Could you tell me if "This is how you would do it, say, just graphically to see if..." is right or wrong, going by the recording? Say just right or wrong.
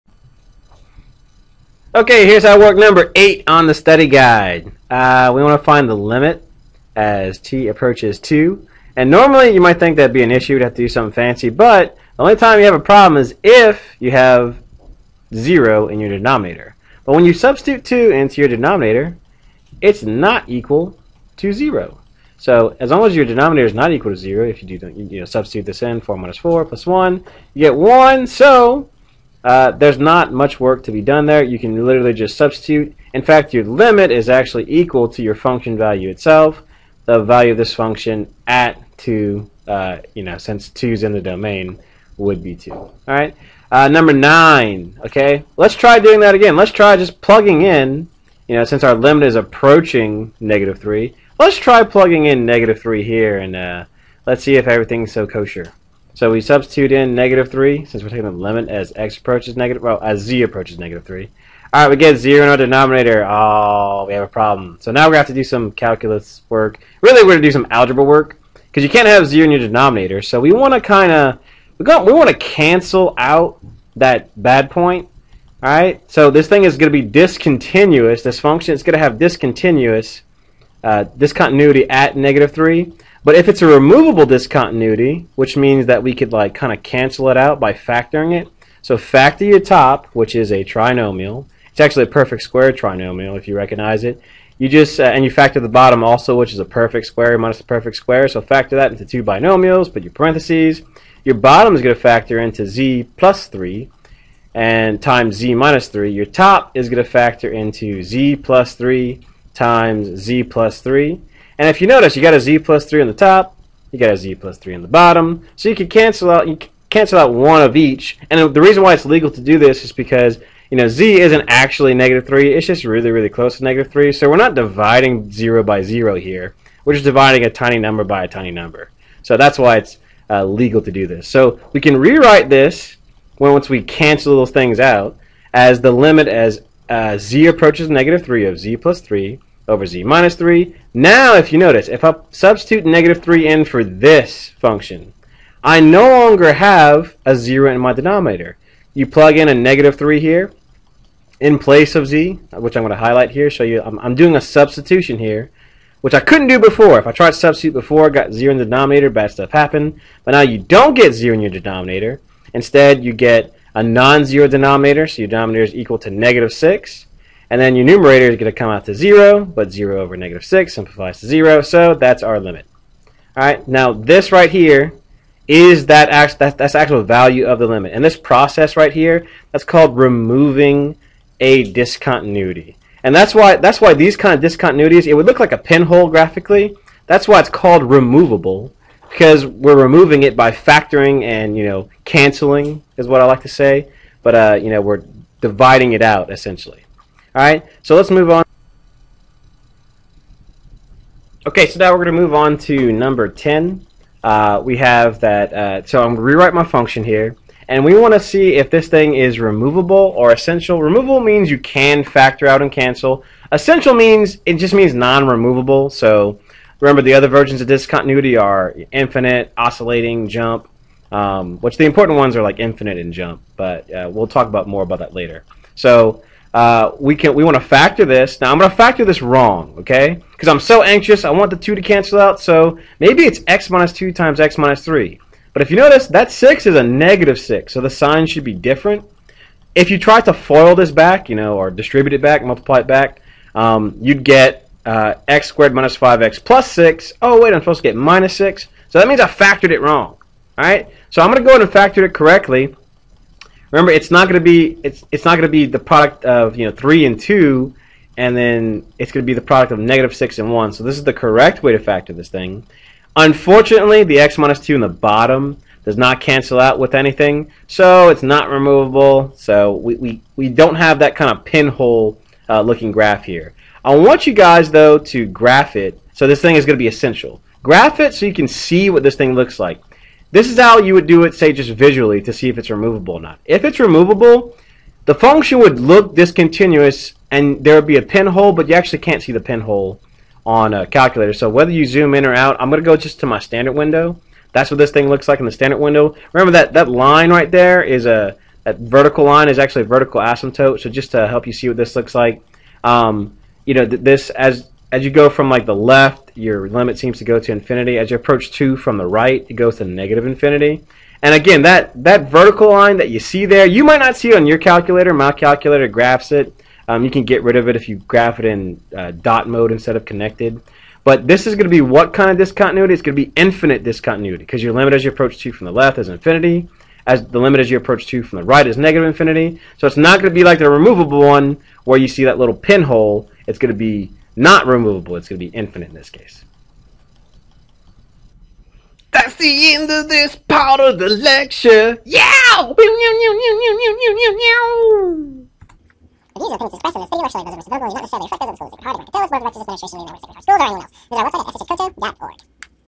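wrong.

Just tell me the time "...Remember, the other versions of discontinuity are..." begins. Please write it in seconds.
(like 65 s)
216 s.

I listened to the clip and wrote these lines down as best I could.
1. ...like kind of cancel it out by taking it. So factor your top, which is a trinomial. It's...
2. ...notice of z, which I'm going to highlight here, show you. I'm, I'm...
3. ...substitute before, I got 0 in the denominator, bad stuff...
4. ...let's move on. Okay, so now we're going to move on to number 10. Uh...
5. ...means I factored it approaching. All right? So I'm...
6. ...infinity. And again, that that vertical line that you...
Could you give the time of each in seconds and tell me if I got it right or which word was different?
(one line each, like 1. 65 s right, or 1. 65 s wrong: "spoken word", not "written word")
1. 86 s wrong: "factoring", not "taking"
2. 151 s wrong: "place", not "notice"
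3. 157 s right
4. 197 s right
5. 249 s wrong: "wrong", not "approaching"
6. 310 s right.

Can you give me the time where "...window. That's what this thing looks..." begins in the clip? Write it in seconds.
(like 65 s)
293 s.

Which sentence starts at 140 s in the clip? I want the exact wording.
Now, if you notice, if I substitute negative 3 in for this function, I no longer have a 0 in my denominator.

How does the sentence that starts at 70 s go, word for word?
So we want to kind of, we, want to cancel out that bad point.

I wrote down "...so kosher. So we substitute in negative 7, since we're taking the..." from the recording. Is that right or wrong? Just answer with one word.
wrong.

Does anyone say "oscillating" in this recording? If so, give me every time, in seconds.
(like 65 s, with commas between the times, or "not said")
219 s.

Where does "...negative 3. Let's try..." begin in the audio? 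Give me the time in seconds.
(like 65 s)
50 s.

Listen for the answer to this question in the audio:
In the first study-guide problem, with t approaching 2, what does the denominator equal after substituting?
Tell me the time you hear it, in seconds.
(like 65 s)
27 s.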